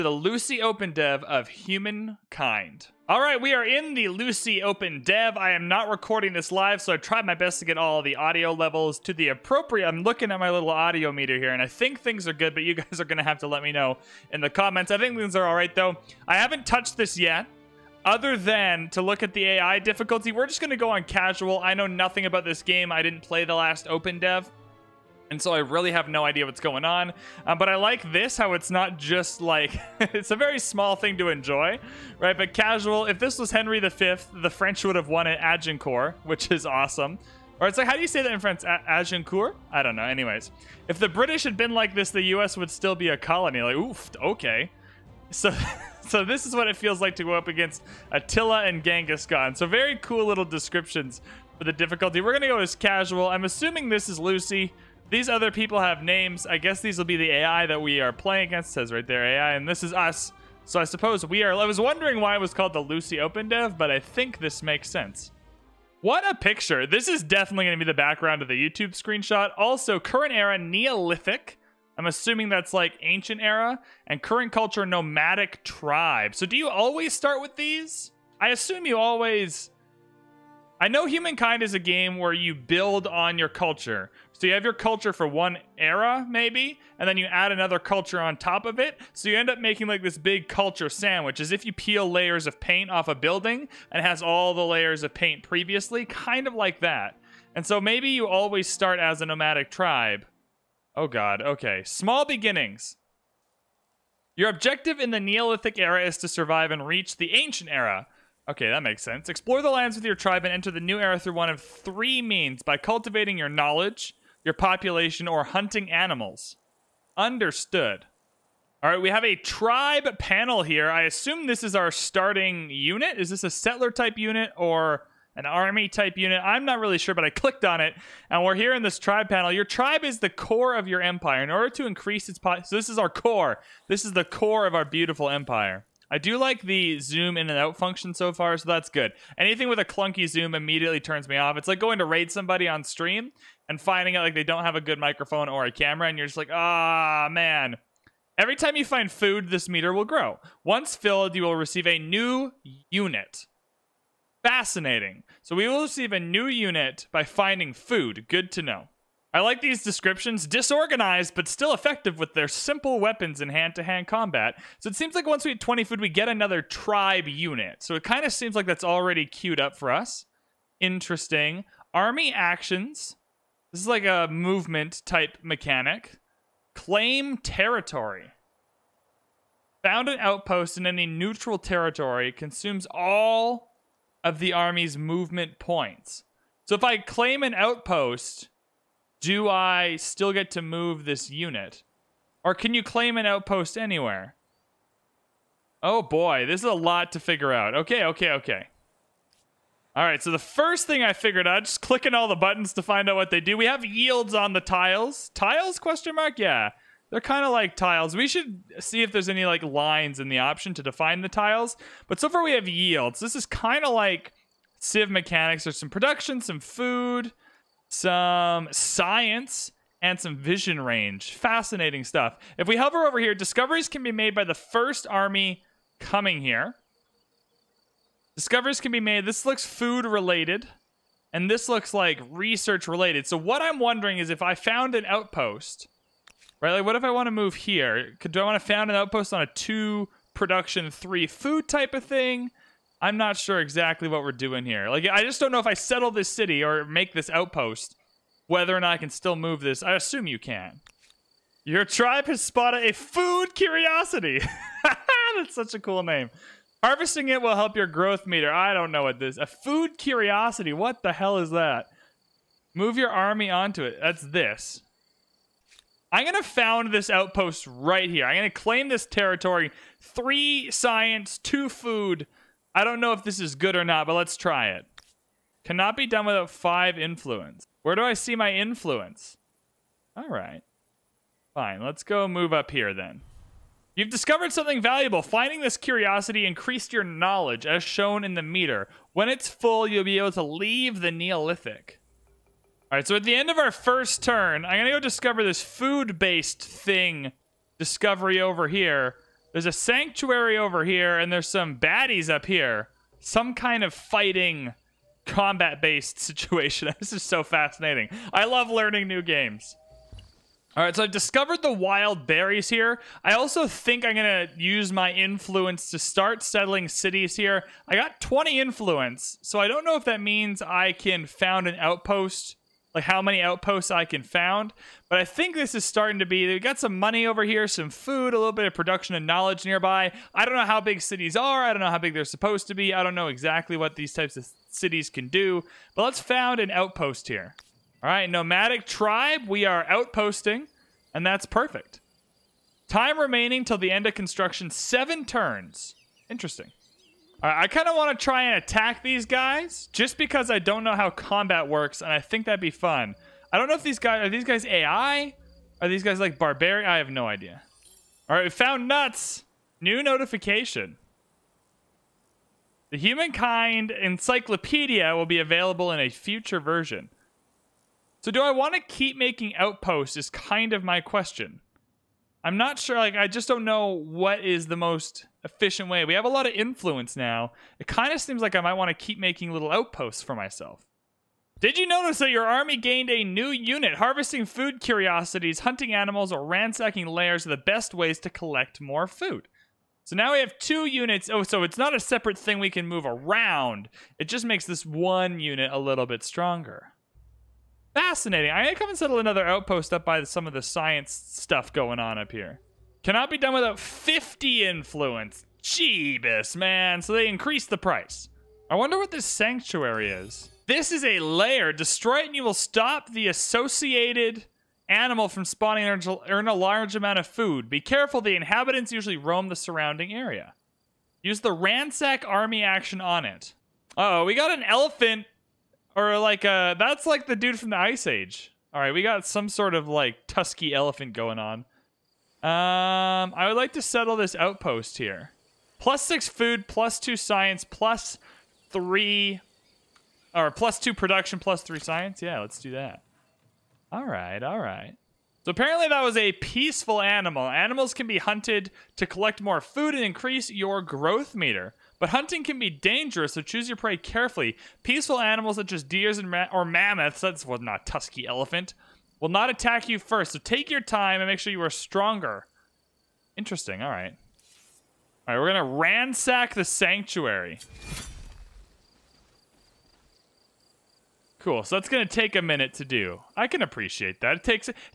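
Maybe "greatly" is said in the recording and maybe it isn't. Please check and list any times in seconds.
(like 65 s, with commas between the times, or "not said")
not said.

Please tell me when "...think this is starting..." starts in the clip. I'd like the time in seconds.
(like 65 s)
325 s.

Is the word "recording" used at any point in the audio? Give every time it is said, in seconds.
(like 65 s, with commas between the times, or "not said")
5 s.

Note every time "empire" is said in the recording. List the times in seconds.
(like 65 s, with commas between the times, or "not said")
131 s, 135 s.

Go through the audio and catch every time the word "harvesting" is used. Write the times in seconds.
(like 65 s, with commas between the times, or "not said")
256 s, 383 s.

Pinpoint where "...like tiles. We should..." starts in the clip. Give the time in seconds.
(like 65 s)
207 s.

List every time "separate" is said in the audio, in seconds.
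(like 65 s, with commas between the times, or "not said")
392 s.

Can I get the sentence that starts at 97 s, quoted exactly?
And so maybe you always start as a nomadic tribe.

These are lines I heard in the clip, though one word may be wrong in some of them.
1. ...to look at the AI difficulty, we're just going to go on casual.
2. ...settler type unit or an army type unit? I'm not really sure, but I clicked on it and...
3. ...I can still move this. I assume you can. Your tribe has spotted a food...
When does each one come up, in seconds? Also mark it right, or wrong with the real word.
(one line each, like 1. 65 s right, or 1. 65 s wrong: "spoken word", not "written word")
1. 18 s right
2. 123 s right
3. 248 s right.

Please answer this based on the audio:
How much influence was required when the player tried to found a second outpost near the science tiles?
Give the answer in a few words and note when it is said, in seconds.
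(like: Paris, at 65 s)
50, at 403 s.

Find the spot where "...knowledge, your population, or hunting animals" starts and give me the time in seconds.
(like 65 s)
113 s.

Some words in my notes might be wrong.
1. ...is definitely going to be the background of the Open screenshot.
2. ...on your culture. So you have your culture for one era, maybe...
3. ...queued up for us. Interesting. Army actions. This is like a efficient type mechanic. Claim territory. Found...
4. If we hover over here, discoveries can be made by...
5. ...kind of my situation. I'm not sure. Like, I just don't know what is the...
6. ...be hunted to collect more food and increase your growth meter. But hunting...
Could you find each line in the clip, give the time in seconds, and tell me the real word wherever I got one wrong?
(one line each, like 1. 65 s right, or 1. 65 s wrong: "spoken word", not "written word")
1. 67 s wrong: "YouTube", not "Open"
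2. 83 s right
3. 169 s wrong: "movement", not "efficient"
4. 222 s right
5. 370 s wrong: "question", not "situation"
6. 448 s right.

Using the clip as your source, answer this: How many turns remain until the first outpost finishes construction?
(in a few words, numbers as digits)
7.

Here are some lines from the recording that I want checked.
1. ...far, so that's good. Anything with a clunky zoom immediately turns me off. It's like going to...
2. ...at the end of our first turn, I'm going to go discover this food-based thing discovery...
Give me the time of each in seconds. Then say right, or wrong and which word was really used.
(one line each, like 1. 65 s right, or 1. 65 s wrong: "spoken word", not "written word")
1. 138 s right
2. 293 s right.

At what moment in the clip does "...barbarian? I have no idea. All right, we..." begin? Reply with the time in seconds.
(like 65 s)
356 s.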